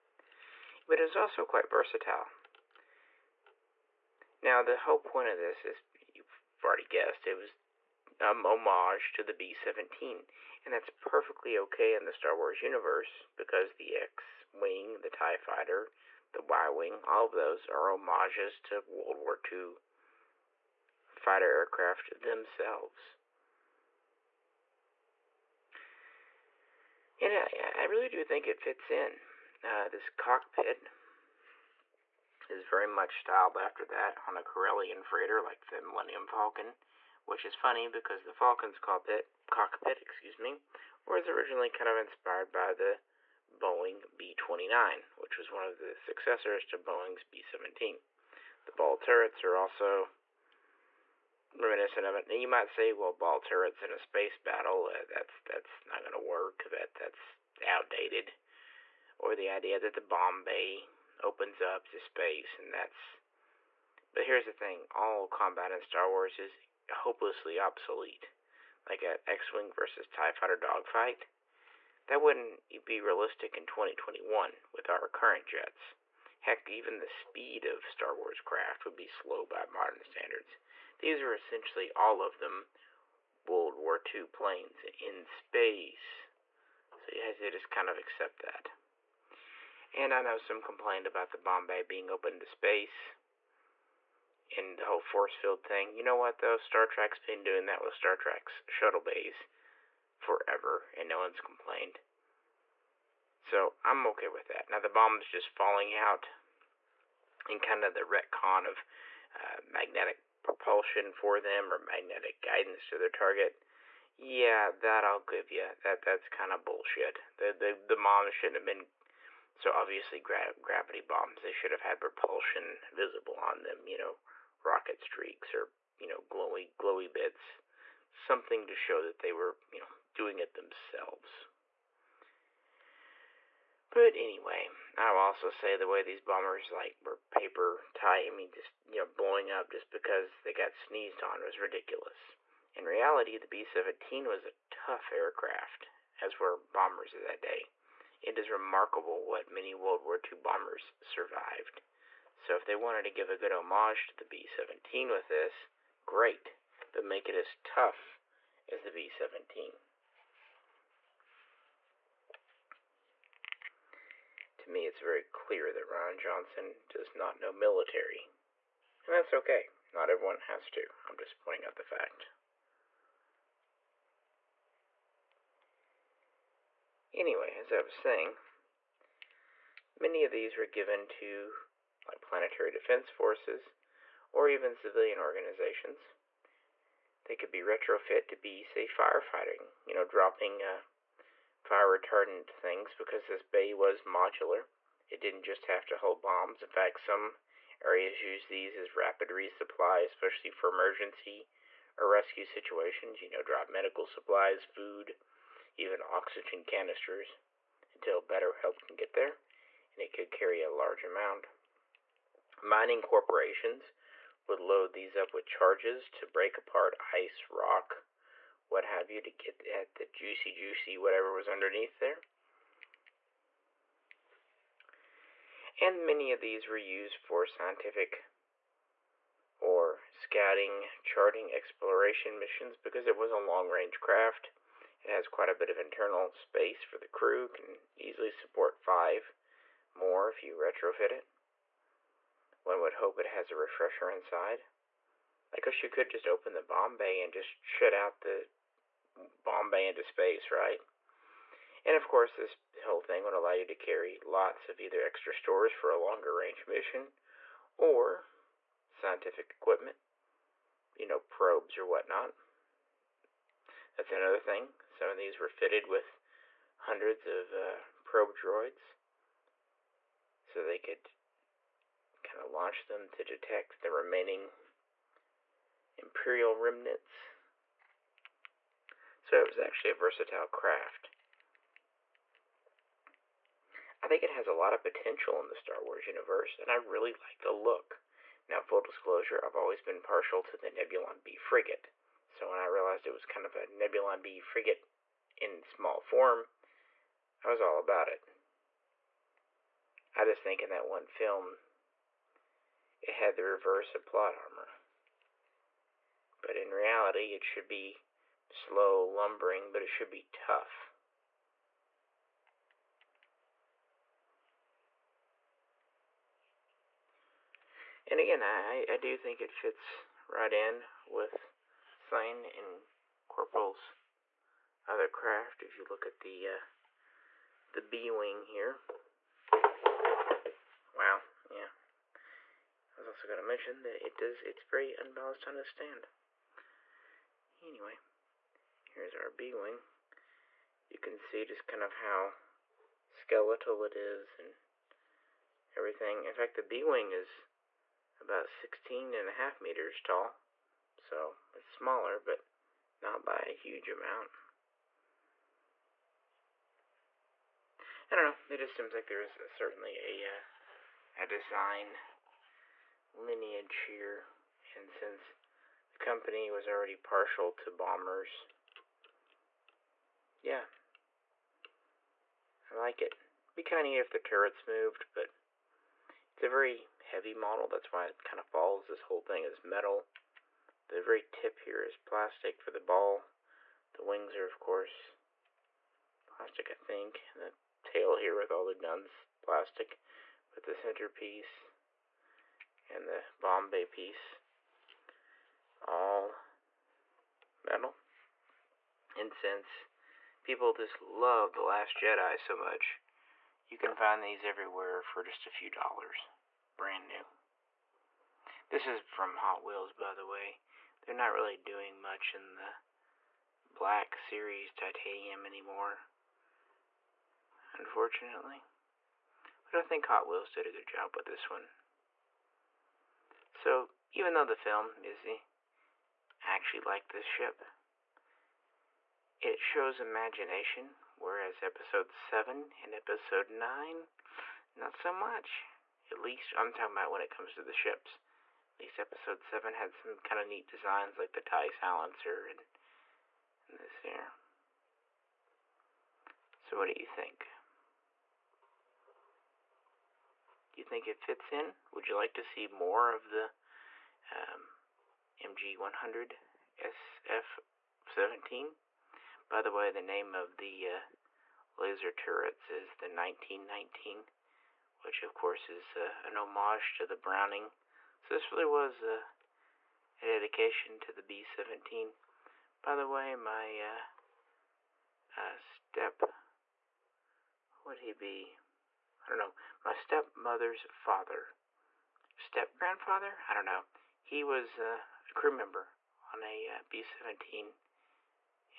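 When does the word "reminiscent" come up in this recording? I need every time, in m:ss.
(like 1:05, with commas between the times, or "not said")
0:51.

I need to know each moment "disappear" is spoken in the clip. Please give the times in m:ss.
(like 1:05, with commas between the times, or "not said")
not said.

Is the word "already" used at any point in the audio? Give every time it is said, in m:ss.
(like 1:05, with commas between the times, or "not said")
0:06, 6:06.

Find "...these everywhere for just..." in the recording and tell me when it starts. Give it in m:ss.
6:44.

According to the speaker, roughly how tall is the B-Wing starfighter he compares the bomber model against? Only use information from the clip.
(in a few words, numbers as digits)
16.5 meters.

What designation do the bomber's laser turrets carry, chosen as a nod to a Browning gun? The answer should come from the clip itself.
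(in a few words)
1919.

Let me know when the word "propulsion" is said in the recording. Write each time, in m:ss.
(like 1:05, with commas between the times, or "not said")
1:50, 2:02.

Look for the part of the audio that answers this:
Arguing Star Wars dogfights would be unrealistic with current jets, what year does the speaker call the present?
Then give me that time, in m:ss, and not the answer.
1:13.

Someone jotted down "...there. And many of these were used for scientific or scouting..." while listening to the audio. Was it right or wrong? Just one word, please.
right.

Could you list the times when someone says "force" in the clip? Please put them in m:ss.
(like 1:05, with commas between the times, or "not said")
1:35, 3:03.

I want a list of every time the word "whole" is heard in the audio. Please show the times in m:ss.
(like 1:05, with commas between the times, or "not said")
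0:04, 1:34, 4:12, 6:19.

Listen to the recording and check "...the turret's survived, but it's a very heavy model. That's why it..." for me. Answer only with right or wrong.
wrong.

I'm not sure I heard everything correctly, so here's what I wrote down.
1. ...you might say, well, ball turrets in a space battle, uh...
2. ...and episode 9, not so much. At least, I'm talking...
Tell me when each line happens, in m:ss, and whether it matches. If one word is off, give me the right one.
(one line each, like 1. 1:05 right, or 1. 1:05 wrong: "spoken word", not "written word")
1. 0:52 right
2. 7:12 right.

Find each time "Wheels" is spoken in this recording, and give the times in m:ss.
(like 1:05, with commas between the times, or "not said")
6:49, 7:00.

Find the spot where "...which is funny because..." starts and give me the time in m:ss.
0:37.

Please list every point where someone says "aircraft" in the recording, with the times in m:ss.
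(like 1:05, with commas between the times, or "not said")
0:21, 2:25.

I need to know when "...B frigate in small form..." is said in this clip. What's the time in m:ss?
4:54.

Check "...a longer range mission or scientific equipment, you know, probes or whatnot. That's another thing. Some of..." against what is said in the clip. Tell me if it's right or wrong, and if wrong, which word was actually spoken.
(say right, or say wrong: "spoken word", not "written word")
right.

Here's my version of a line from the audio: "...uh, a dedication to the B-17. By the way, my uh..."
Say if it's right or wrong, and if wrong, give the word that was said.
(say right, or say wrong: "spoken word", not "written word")
right.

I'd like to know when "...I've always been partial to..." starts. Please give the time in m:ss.
4:49.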